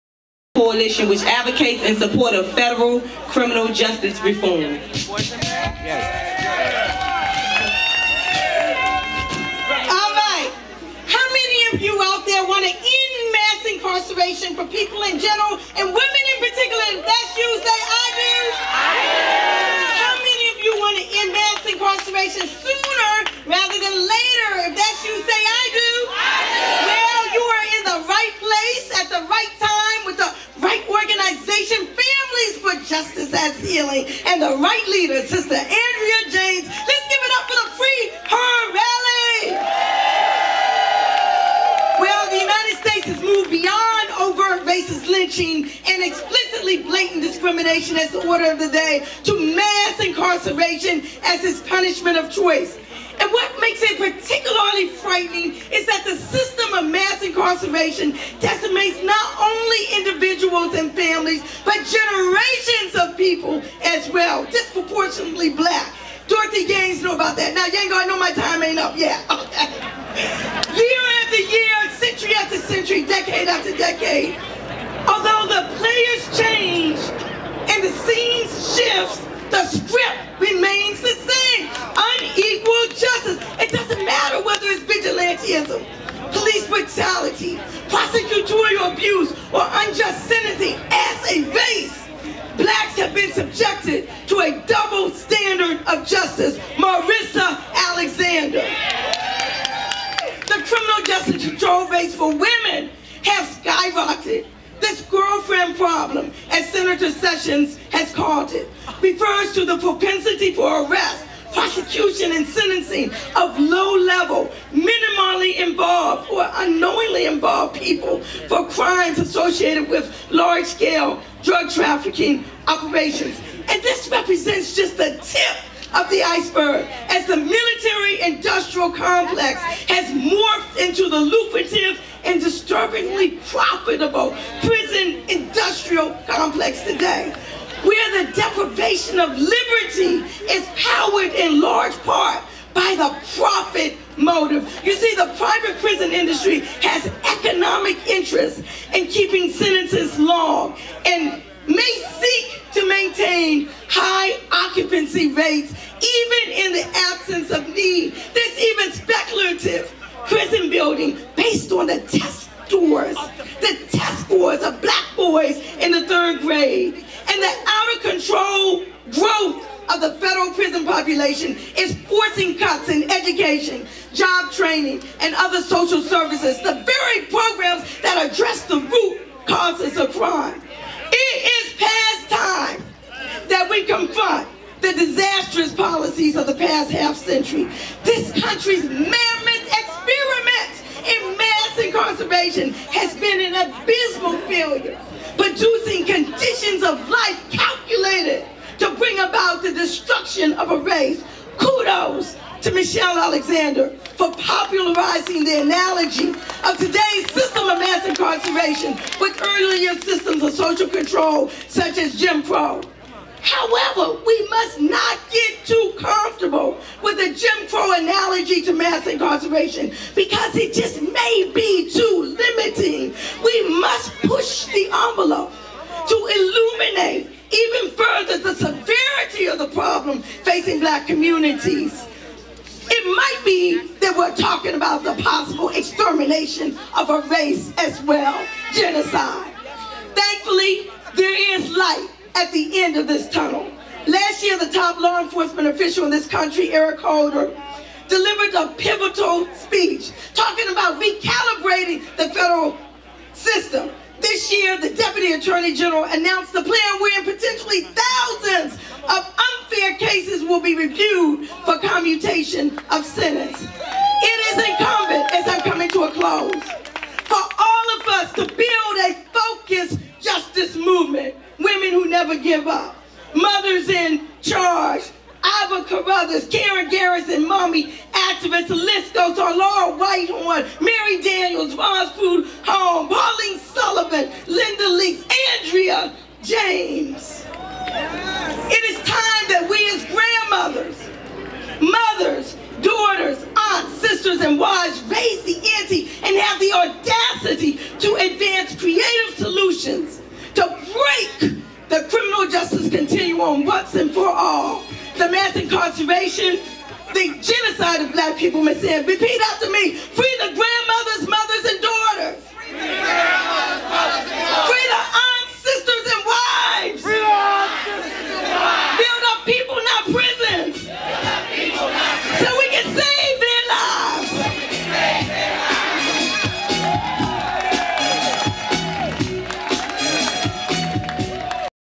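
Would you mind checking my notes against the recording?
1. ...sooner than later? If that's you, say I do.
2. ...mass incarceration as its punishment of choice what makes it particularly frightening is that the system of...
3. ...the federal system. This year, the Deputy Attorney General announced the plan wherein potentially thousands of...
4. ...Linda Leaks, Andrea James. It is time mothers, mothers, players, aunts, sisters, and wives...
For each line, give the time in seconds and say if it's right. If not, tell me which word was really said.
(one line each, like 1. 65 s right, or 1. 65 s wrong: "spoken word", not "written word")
1. 23 s wrong: "rather", not "sooner"
2. 49 s right
3. 252 s right
4. 284 s wrong: "daughters", not "players".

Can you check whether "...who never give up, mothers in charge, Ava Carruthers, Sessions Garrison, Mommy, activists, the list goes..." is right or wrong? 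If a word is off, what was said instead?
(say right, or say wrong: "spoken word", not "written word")
wrong: "Karen", not "Sessions".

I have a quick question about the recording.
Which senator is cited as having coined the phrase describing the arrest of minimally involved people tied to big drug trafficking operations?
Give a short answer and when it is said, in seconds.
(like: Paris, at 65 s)
Senator Sessions, at 106 s.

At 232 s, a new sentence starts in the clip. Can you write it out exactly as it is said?
It might be that we're talking about the possible extermination of a race as well, genocide.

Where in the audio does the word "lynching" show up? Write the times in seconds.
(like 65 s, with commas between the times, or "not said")
45 s.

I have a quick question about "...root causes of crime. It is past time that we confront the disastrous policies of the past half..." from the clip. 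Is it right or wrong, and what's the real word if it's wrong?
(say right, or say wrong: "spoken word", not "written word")
right.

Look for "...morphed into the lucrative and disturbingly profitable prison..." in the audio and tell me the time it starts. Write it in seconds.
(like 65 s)
130 s.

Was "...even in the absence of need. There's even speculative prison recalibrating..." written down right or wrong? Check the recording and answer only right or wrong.
wrong.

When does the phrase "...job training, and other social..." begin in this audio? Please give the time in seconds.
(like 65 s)
174 s.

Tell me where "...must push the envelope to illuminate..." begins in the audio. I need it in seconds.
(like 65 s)
223 s.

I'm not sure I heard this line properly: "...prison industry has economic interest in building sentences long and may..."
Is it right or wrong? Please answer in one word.
wrong.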